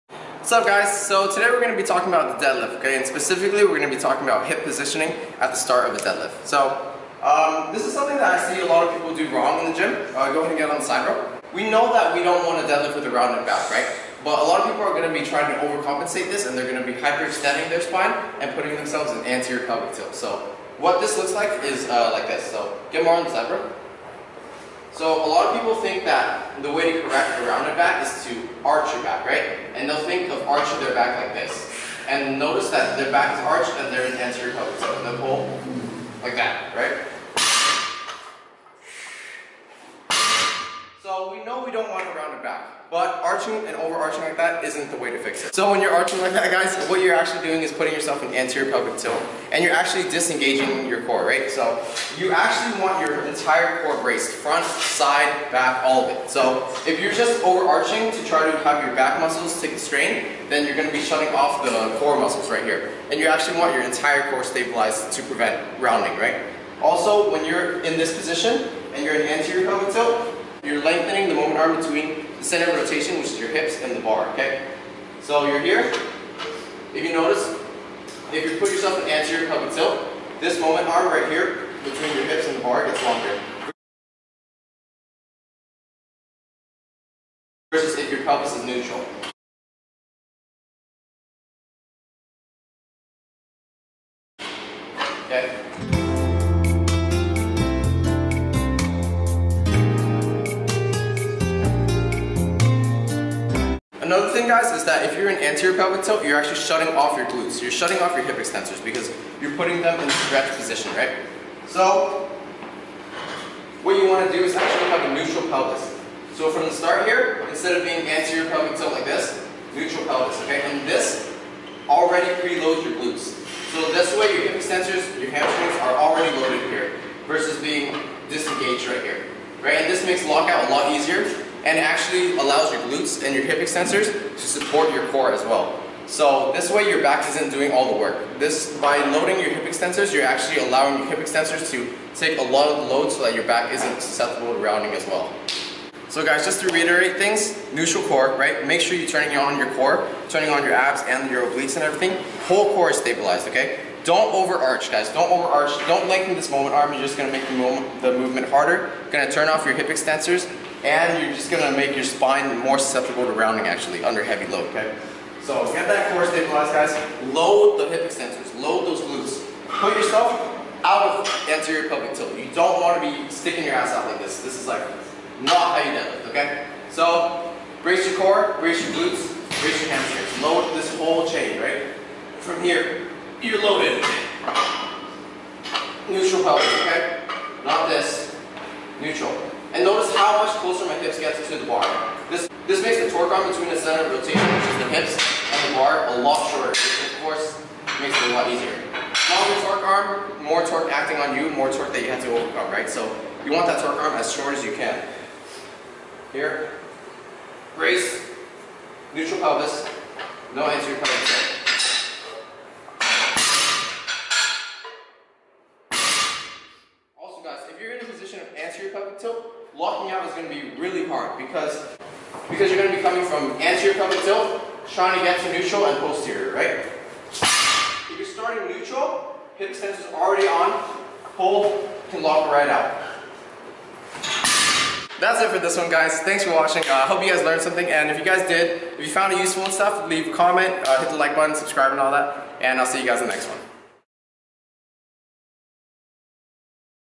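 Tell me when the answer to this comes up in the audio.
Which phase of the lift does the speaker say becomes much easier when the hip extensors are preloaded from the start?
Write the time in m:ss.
2:10.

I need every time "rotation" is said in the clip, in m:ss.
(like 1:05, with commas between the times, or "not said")
1:12, 3:14.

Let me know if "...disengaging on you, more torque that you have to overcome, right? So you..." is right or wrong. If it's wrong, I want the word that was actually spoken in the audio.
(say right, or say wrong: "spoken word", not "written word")
wrong: "acting", not "disengaging".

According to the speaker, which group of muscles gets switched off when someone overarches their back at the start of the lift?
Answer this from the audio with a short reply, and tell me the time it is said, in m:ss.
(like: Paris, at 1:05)
core muscles, at 1:01.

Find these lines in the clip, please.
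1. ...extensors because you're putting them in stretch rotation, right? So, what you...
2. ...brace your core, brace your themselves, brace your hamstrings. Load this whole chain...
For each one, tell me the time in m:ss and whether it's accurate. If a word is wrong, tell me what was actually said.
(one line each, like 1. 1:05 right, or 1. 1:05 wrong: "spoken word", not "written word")
1. 1:48 wrong: "position", not "rotation"
2. 2:57 wrong: "glutes", not "themselves".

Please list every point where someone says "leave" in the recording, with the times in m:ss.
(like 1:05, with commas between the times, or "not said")
4:00.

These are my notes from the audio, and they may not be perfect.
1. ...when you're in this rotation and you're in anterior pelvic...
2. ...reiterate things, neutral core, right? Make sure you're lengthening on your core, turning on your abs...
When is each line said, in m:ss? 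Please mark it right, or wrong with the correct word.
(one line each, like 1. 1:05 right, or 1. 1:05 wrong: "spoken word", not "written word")
1. 1:07 wrong: "position", not "rotation"
2. 2:26 wrong: "turning", not "lengthening".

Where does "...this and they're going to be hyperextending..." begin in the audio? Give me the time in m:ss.
0:16.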